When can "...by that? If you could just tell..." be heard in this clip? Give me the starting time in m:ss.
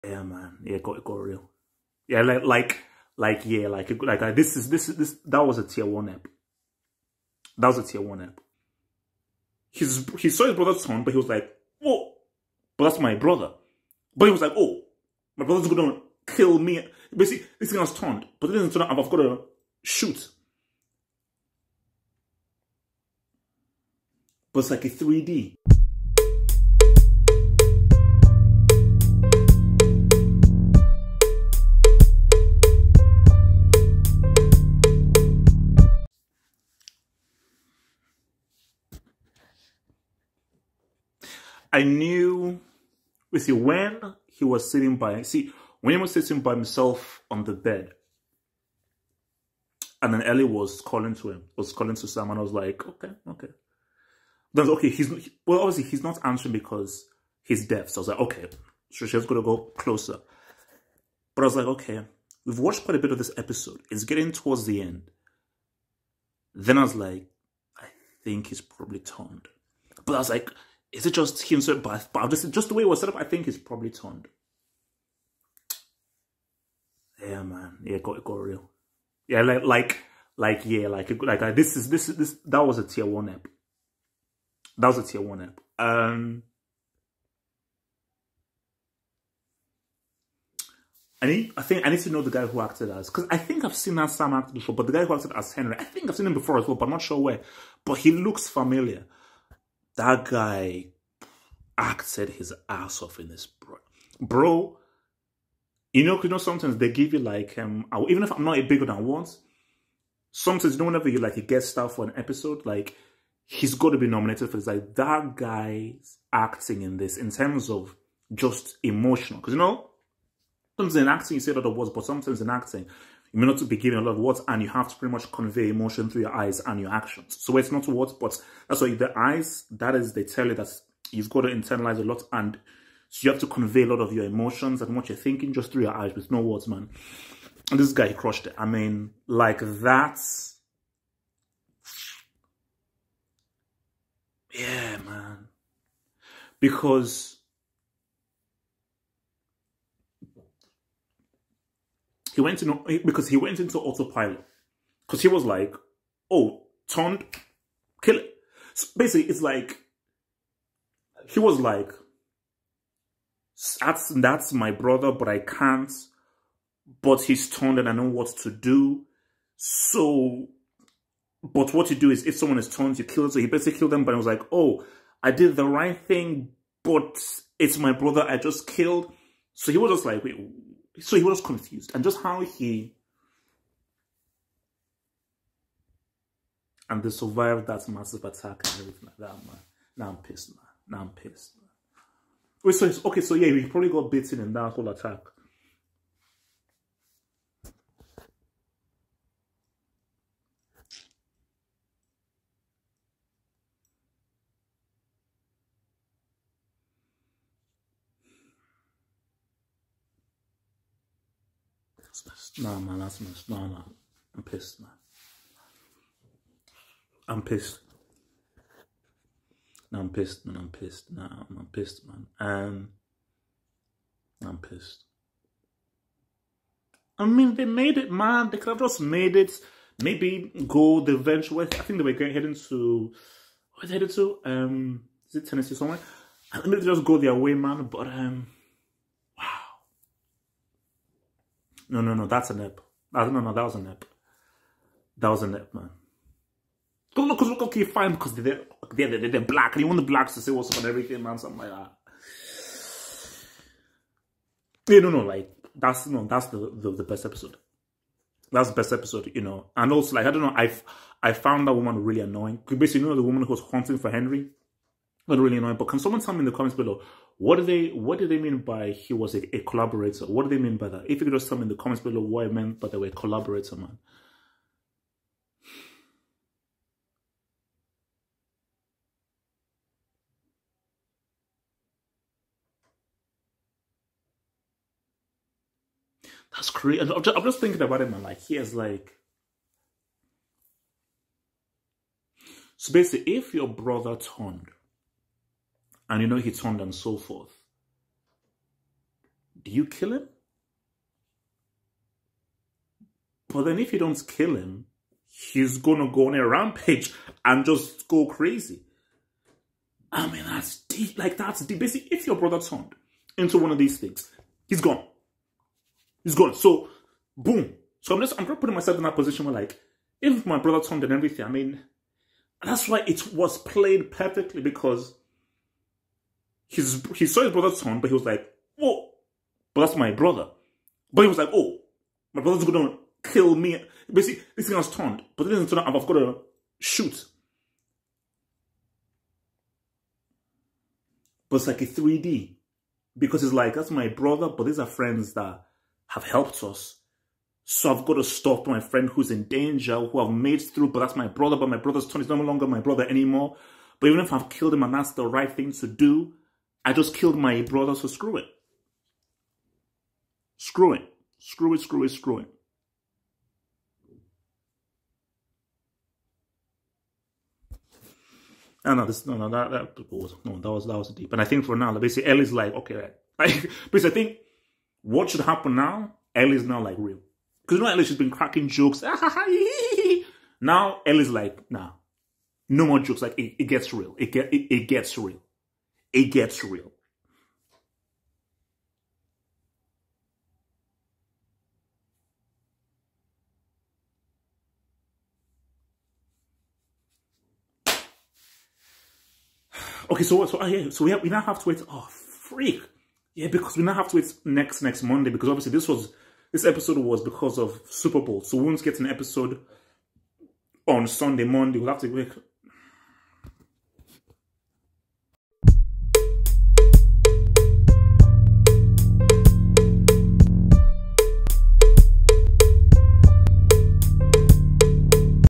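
4:30.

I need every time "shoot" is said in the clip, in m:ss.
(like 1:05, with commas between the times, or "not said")
0:19, 5:36.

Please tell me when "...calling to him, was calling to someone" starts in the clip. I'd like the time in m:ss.
0:50.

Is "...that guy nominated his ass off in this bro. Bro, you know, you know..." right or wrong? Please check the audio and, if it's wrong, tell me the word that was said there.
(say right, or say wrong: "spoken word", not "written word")
wrong: "acted", not "nominated".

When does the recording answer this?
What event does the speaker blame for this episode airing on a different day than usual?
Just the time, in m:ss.
6:47.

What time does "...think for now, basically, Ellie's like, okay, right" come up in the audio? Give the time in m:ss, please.
6:11.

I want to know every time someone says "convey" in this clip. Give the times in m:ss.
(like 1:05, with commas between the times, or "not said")
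2:05, 2:13.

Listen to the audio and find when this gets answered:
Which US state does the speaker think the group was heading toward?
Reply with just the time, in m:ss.
3:55.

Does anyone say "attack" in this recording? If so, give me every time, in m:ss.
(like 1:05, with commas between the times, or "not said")
3:08, 3:14.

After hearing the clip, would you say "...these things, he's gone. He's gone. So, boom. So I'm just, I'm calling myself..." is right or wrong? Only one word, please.
wrong.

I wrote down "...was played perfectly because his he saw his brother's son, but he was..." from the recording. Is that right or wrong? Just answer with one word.
right.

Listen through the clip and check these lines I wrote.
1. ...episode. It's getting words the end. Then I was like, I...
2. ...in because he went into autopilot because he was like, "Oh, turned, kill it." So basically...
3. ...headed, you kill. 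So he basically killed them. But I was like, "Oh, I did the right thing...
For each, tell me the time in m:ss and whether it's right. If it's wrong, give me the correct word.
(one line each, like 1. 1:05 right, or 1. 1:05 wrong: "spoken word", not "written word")
1. 1:03 wrong: "towards", not "words"
2. 2:32 right
3. 2:52 wrong: "turned", not "headed".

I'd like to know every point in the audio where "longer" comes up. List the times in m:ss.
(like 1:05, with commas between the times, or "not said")
5:52.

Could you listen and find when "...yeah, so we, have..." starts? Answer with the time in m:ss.
6:40.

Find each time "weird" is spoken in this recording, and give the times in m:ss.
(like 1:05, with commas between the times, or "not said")
not said.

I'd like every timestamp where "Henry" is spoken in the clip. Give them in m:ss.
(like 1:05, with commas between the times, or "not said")
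1:35, 4:24.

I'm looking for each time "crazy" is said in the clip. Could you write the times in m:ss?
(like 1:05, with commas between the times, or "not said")
4:46, 5:08.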